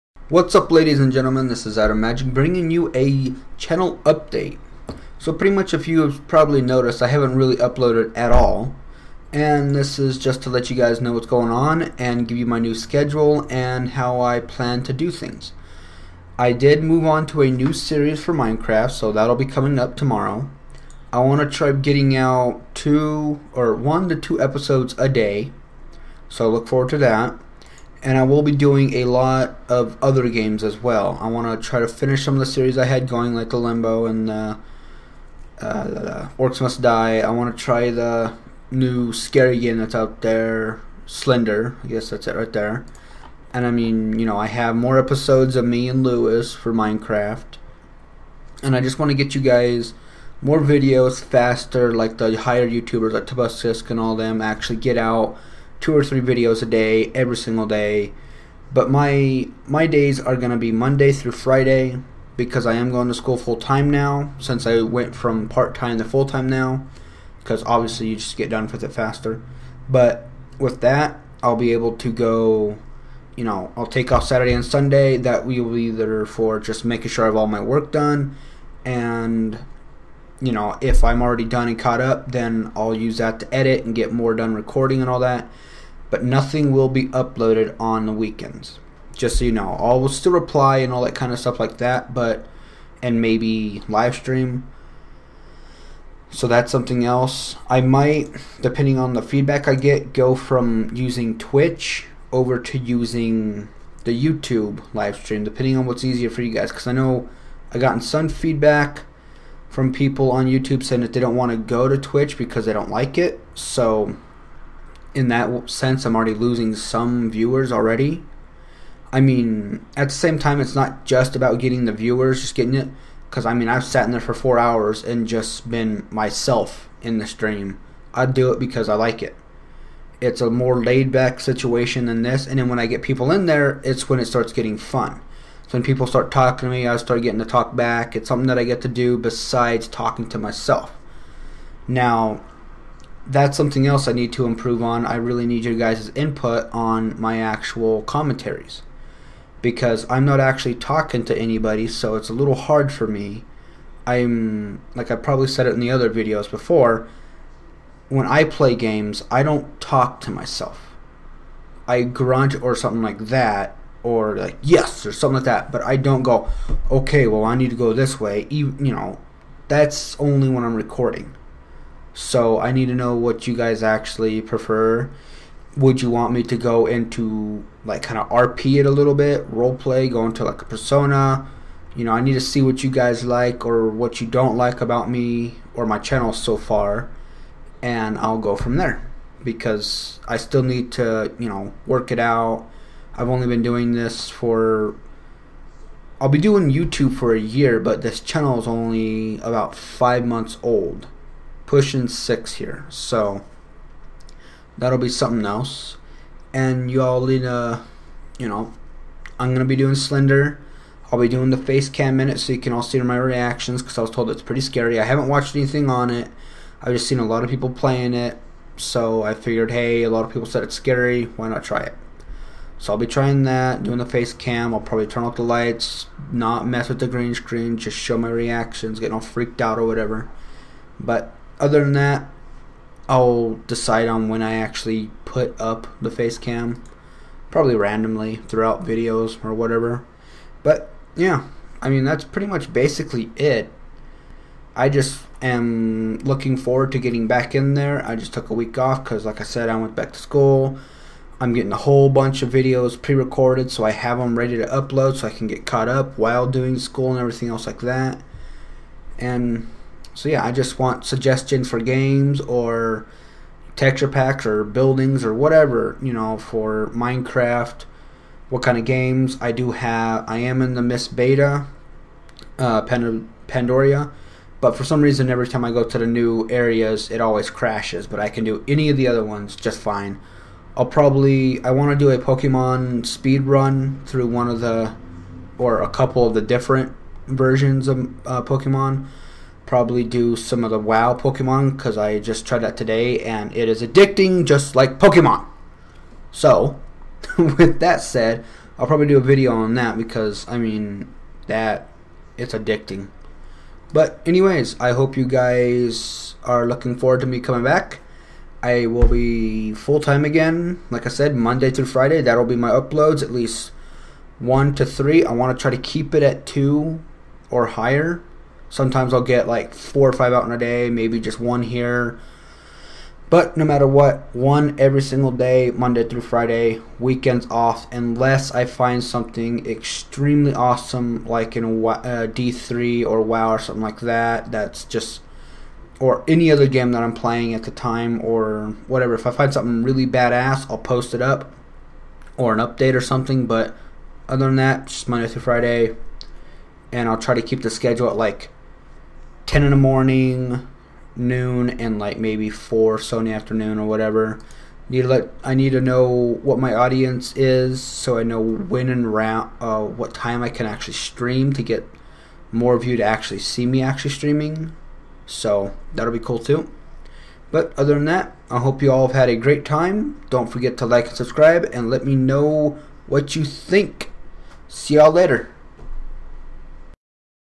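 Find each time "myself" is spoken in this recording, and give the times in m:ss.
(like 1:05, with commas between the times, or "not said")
2:06, 2:20, 2:40.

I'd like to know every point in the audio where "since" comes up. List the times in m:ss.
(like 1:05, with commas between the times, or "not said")
1:04.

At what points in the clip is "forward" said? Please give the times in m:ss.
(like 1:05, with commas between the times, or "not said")
0:26, 4:06, 5:06.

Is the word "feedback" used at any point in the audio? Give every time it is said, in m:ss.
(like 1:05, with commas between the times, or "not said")
1:39, 1:48.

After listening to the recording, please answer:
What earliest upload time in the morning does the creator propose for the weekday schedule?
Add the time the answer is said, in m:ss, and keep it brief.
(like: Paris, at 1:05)
10 in the morning, at 5:49.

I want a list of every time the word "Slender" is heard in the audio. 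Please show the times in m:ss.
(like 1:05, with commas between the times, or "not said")
0:41, 3:29.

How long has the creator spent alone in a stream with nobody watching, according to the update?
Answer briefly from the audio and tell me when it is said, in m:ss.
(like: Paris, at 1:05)
4 hours, at 2:04.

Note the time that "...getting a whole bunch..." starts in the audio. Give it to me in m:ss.
4:11.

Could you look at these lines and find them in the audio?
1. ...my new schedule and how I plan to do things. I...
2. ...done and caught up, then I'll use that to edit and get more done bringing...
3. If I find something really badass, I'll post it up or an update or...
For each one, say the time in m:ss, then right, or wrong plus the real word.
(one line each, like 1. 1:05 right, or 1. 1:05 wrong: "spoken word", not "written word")
1. 0:12 right
2. 1:21 wrong: "recording", not "bringing"
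3. 5:39 right.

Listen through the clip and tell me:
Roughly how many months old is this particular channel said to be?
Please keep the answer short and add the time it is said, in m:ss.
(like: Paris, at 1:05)
5 months, at 3:19.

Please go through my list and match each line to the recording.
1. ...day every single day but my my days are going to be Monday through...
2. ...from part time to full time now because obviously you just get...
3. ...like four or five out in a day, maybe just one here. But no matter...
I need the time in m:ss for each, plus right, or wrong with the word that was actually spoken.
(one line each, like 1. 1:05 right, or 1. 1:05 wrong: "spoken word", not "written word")
1. 0:56 right
2. 1:05 right
3. 5:19 right.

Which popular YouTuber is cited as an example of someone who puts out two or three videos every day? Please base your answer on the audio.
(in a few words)
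Tobuscus.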